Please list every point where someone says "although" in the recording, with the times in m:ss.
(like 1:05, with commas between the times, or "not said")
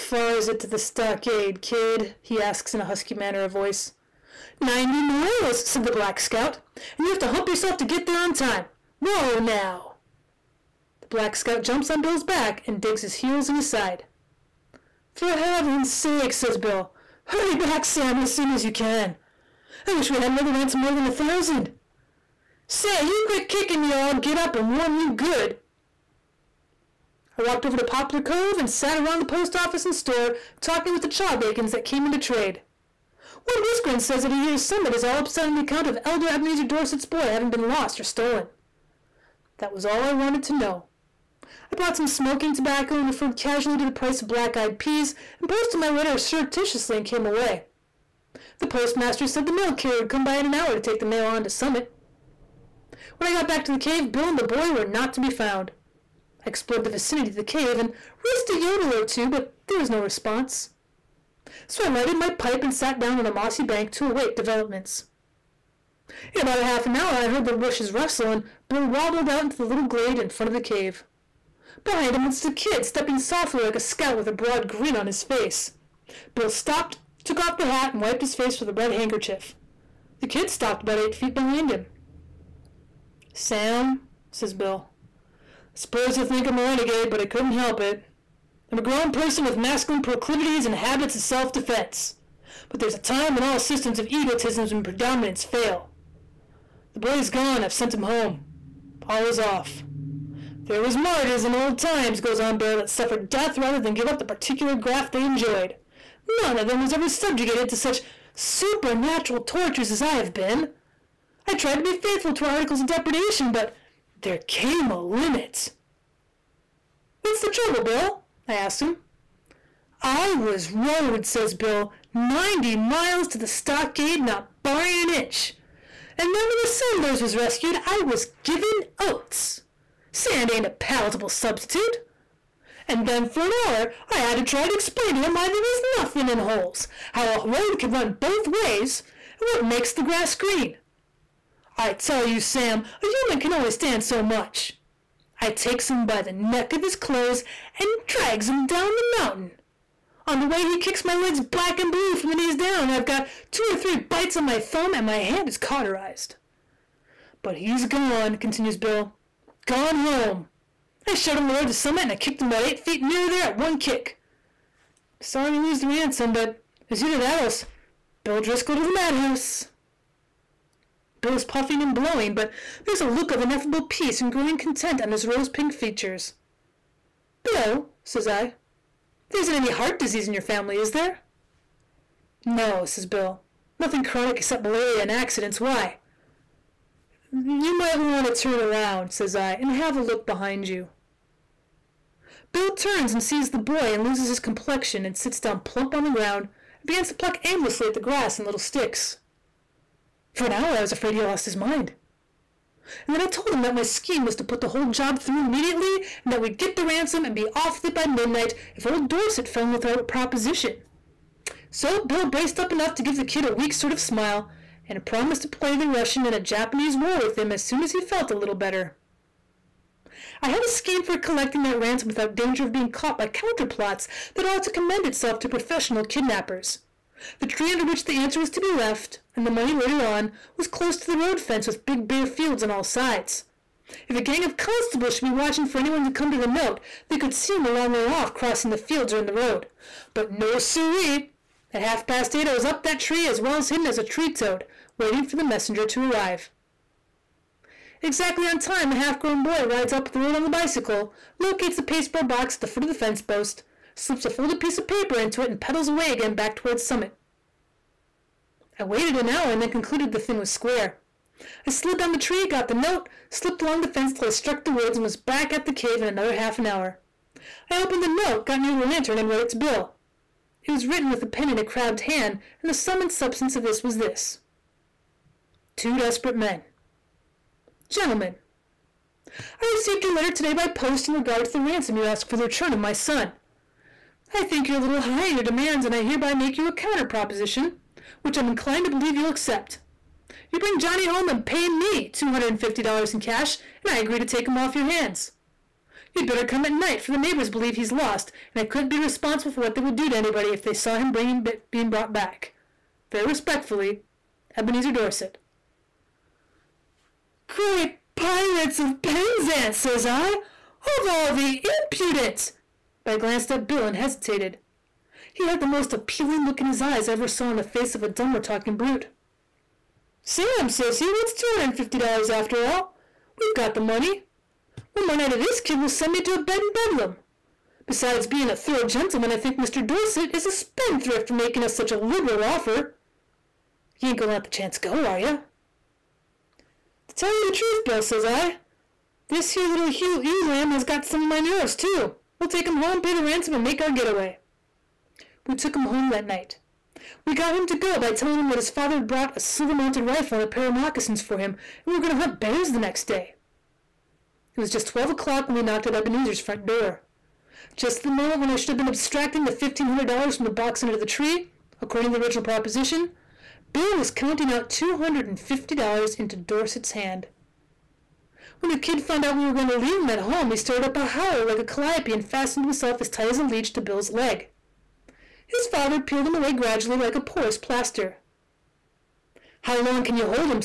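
not said.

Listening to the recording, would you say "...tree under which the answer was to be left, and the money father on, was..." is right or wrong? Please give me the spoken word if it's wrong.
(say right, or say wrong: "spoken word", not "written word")
wrong: "later", not "father".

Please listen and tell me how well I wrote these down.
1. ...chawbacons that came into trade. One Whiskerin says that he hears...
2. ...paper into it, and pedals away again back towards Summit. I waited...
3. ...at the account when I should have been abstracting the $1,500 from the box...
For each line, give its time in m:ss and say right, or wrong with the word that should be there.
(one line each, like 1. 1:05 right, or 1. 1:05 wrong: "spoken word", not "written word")
1. 0:31 right
2. 4:14 right
3. 5:57 wrong: "moment", not "account".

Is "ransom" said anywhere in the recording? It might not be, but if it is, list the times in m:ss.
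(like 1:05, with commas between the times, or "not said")
0:20, 2:45, 3:26, 3:41, 4:41, 5:43.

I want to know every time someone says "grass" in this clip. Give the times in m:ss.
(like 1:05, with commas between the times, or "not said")
2:20, 3:18.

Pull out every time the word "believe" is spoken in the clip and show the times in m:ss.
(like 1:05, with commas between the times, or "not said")
4:48, 4:57.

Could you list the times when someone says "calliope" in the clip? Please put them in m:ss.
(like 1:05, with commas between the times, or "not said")
6:11.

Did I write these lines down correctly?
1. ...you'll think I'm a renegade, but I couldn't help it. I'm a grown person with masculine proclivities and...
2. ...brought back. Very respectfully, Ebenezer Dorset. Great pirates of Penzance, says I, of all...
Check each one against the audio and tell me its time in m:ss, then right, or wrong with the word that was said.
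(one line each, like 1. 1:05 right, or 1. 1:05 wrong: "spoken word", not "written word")
1. 1:26 right
2. 5:01 right.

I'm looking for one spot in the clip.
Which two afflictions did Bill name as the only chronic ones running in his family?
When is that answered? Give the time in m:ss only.
3:04.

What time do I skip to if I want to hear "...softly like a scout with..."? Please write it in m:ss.
1:13.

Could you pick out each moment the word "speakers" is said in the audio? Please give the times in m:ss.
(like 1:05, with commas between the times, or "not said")
not said.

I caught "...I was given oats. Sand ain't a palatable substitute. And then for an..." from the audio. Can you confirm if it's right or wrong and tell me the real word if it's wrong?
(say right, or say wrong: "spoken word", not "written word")
right.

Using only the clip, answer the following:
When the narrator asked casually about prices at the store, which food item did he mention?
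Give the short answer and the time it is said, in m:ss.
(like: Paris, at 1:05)
black eyed peas, at 0:44.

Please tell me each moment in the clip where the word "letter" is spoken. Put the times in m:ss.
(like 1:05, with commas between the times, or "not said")
0:45, 4:40.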